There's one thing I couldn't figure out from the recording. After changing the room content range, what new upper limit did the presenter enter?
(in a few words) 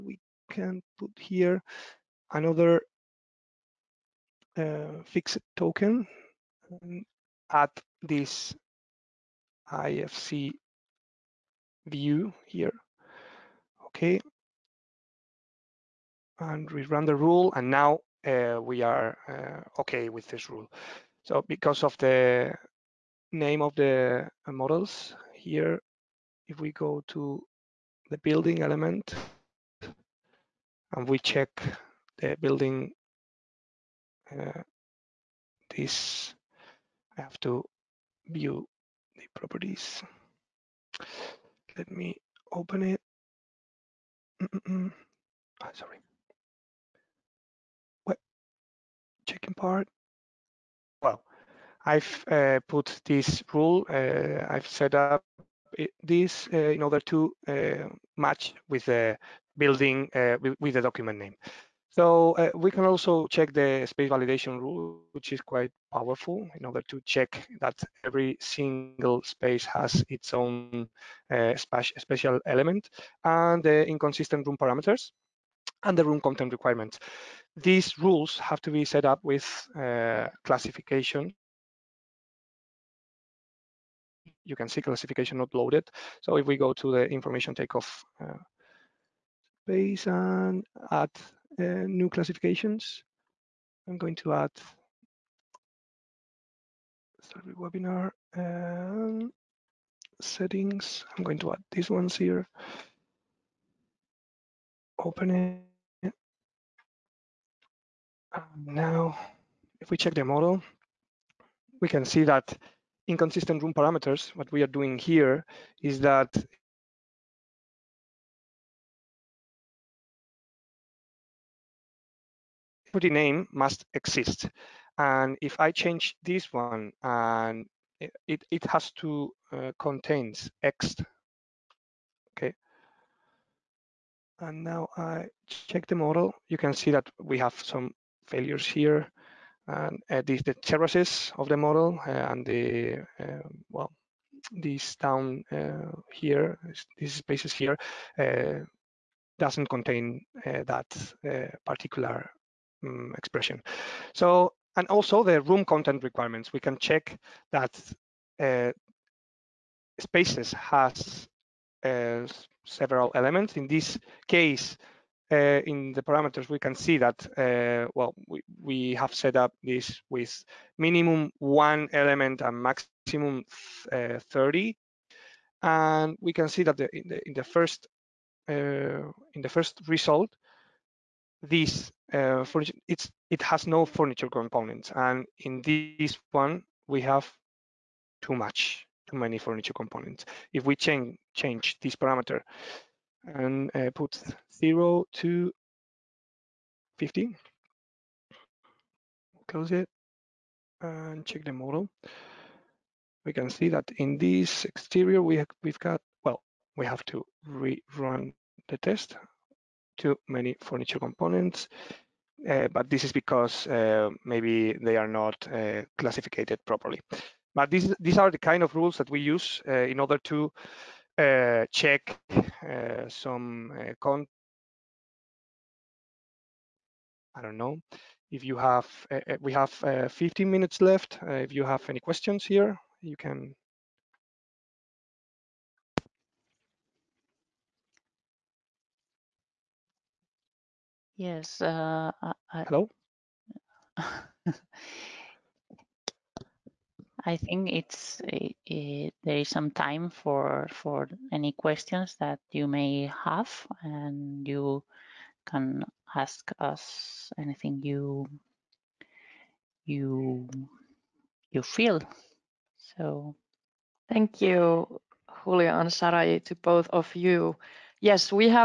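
50.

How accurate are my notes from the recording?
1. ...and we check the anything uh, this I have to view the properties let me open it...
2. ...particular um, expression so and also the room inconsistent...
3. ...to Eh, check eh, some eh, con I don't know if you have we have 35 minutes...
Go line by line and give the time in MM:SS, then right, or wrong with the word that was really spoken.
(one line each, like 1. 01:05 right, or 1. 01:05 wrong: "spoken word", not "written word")
1. 00:30 wrong: "building", not "anything"
2. 02:31 wrong: "content", not "inconsistent"
3. 03:40 wrong: "15", not "35".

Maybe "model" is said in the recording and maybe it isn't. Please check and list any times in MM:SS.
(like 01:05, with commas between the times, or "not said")
00:24, 01:50, 02:15, 02:21, 03:21.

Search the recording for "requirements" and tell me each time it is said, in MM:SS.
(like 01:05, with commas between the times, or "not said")
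01:16, 02:36.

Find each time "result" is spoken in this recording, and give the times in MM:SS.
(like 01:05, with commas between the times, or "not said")
02:59.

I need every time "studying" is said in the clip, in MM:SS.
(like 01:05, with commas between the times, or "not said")
not said.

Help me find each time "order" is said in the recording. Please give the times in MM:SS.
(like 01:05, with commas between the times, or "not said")
00:56, 01:06, 03:39.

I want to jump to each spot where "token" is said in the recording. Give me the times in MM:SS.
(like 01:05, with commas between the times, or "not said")
00:05.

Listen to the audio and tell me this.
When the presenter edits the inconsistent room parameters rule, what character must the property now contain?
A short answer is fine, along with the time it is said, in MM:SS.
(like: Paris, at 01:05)
X, at 02:09.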